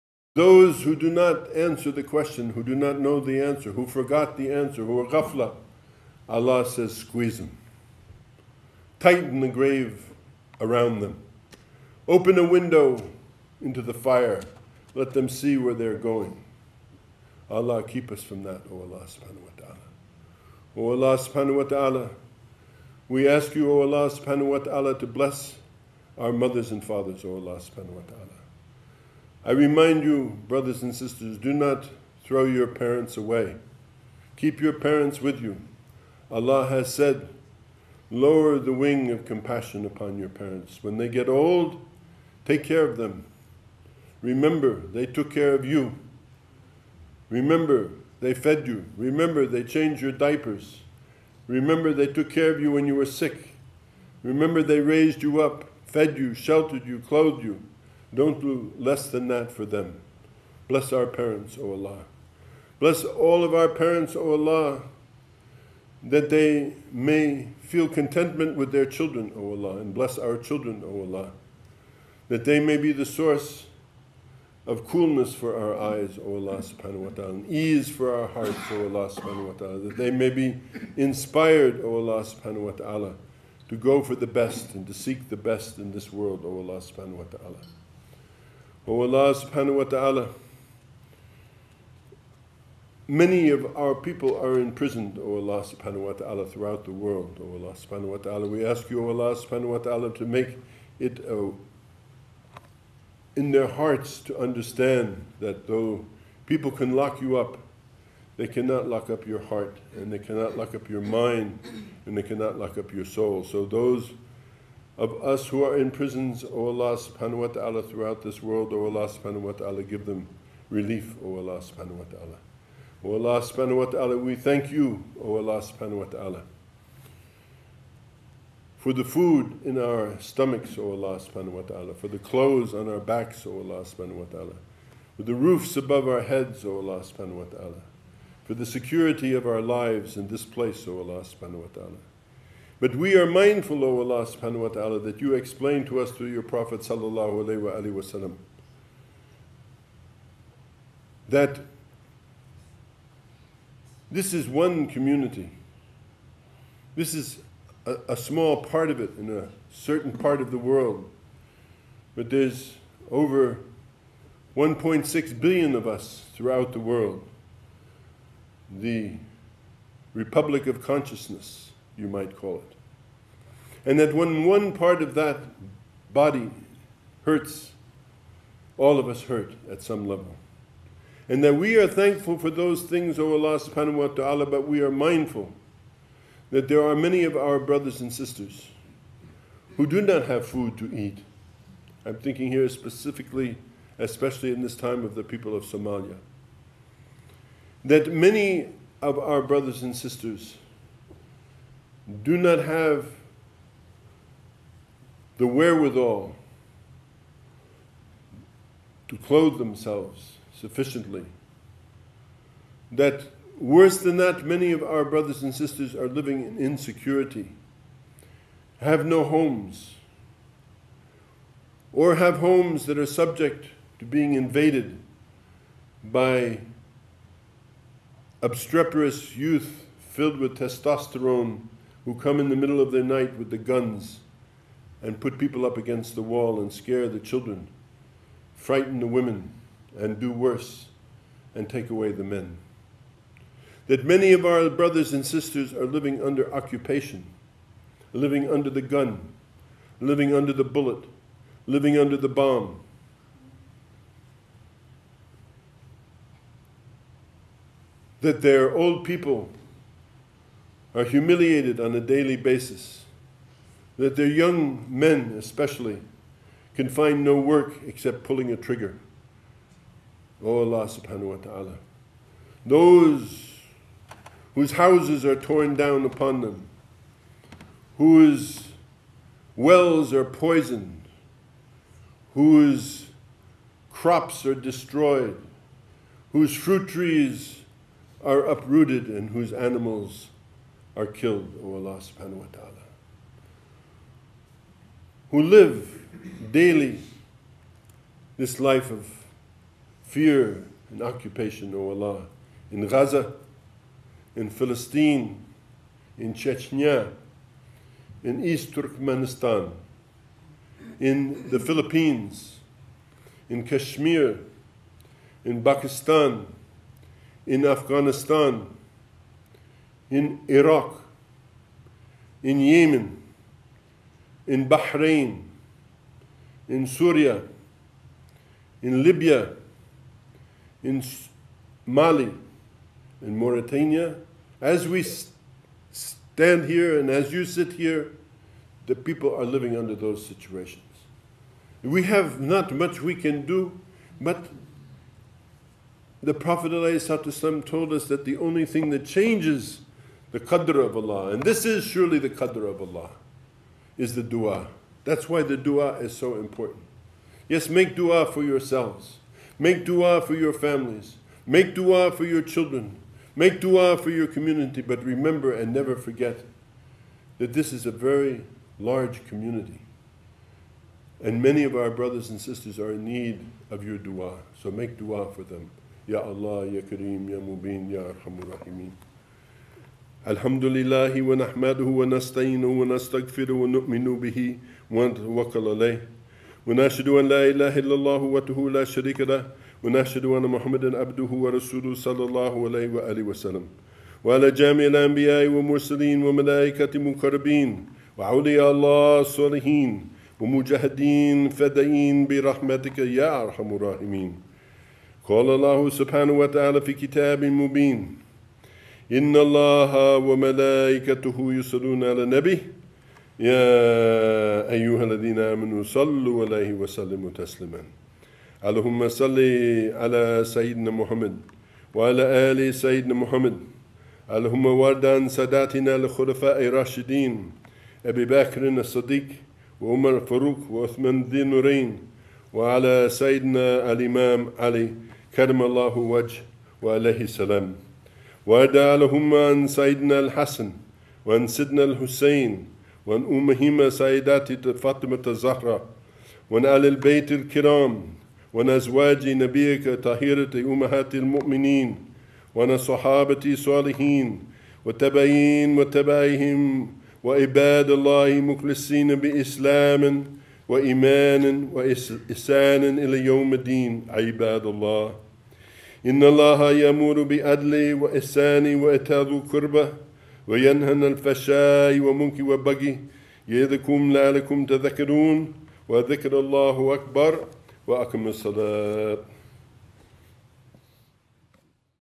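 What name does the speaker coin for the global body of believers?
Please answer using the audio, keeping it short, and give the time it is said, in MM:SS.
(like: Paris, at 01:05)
Republic of Consciousness, at 02:48.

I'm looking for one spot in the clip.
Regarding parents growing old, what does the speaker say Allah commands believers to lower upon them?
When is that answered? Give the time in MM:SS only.
00:38.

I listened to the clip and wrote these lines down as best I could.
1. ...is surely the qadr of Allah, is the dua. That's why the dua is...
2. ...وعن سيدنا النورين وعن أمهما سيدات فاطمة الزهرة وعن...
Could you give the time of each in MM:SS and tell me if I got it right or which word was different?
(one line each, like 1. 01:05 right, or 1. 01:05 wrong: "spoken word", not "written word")
1. 05:51 right
2. 07:21 wrong: "الحسين", not "النورين".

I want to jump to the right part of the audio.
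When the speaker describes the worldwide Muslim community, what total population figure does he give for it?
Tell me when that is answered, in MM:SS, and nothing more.
02:44.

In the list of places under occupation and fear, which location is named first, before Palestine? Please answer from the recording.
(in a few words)
Gaza.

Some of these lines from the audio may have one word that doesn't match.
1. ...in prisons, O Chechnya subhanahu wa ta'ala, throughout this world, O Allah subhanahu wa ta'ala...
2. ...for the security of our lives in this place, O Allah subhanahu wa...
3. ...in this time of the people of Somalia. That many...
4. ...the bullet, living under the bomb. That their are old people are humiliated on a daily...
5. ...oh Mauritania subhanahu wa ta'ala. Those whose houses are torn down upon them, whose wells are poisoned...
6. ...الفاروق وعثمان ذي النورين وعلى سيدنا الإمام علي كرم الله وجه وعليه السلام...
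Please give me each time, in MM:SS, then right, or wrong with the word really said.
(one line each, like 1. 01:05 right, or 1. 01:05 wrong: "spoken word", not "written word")
1. 01:55 wrong: "Allah", not "Chechnya"
2. 02:18 right
3. 03:14 right
4. 04:10 right
5. 04:30 wrong: "Allah", not "Mauritania"
6. 07:10 right.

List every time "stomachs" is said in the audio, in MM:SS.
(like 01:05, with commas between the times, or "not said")
02:10.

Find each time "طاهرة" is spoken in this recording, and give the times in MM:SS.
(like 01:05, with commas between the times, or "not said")
07:29.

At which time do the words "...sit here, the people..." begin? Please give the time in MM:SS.
05:37.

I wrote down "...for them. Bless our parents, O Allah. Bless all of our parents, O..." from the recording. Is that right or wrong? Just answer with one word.
right.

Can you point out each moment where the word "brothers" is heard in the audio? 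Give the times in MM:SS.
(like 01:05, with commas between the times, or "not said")
00:30, 03:07, 03:19, 03:35, 04:04, 06:11.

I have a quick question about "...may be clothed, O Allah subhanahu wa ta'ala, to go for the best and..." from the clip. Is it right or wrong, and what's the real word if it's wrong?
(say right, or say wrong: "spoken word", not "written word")
wrong: "inspired", not "clothed".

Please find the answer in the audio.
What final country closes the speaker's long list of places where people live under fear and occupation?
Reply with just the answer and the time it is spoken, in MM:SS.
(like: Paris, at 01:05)
Mauritania, at 05:33.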